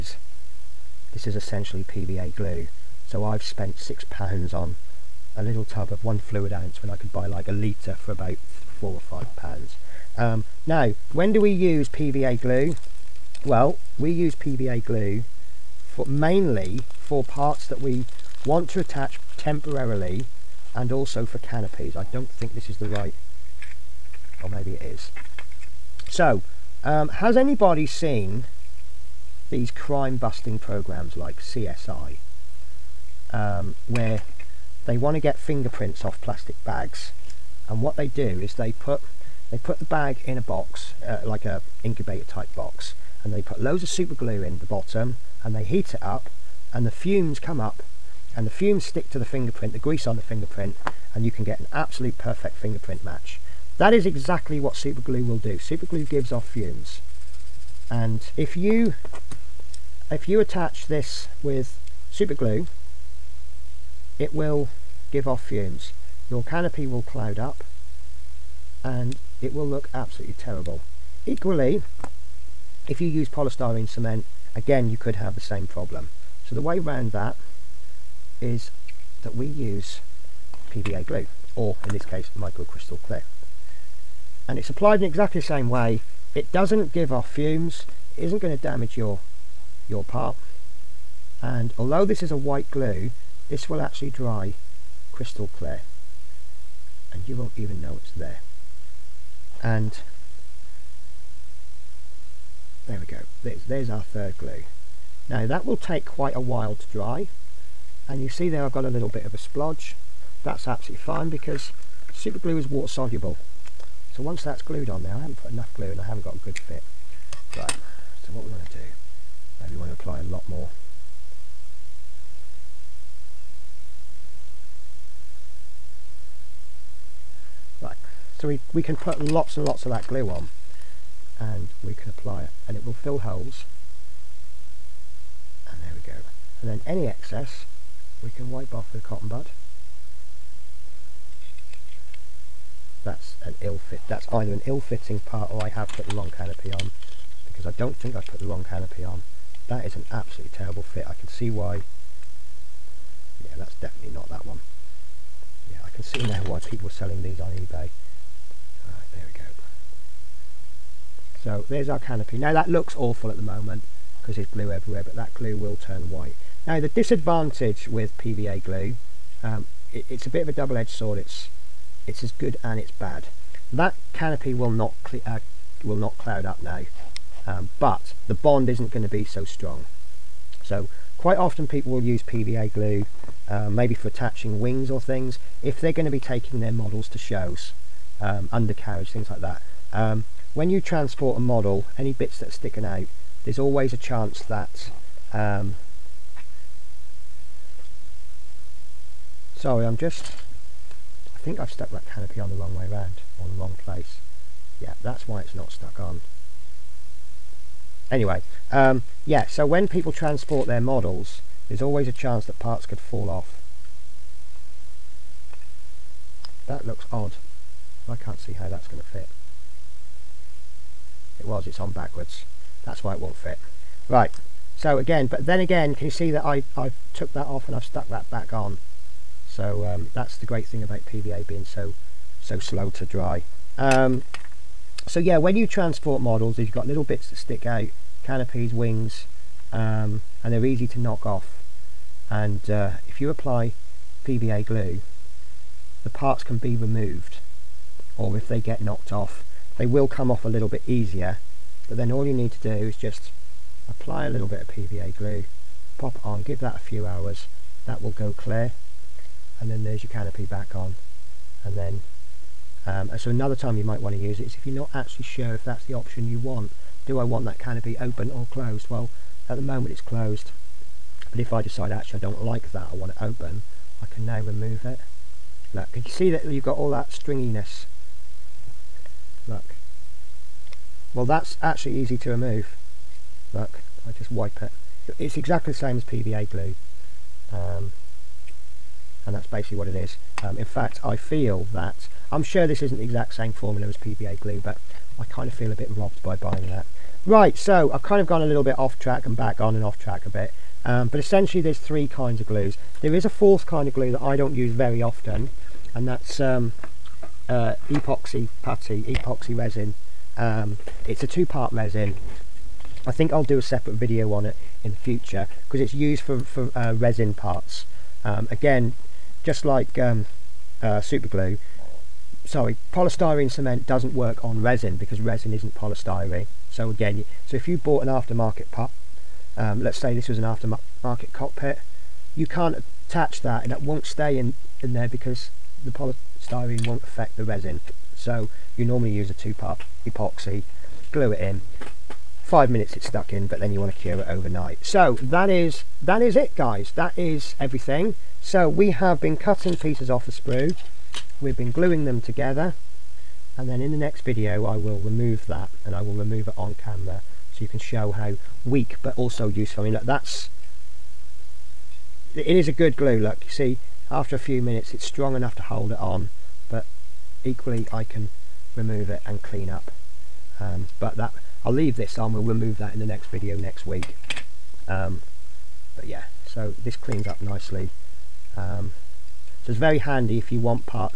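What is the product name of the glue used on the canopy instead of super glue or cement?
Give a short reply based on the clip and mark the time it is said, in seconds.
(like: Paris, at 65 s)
Microcrystal Clear, at 82 s.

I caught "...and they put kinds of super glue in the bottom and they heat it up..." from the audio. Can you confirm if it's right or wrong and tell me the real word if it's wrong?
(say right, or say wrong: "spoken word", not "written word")
wrong: "loads", not "kinds".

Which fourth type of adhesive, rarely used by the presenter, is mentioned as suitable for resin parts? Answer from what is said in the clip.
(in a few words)
epoxy resin.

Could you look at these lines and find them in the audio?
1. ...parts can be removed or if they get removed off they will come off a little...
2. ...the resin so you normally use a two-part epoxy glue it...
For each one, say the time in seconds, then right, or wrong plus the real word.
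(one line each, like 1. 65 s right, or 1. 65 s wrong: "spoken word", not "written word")
1. 246 s wrong: "knocked", not "removed"
2. 337 s right.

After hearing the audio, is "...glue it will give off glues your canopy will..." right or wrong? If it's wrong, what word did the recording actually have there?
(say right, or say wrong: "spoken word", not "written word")
wrong: "fumes", not "glues".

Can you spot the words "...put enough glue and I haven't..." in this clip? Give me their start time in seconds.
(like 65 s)
115 s.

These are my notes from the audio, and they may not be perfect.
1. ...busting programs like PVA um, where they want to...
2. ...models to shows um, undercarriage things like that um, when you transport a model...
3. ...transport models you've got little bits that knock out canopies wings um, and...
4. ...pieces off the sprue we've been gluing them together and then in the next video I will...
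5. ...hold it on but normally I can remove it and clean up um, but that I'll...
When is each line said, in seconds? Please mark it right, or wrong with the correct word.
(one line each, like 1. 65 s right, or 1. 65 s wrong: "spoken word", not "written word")
1. 30 s wrong: "CSI", not "PVA"
2. 186 s right
3. 235 s wrong: "stick", not "knock"
4. 349 s right
5. 365 s wrong: "equally", not "normally".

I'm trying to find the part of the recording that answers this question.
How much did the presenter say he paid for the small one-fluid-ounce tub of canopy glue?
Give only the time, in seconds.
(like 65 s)
3 s.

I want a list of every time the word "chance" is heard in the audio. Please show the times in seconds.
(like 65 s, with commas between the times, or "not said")
193 s, 212 s.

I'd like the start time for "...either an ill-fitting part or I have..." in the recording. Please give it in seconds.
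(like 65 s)
144 s.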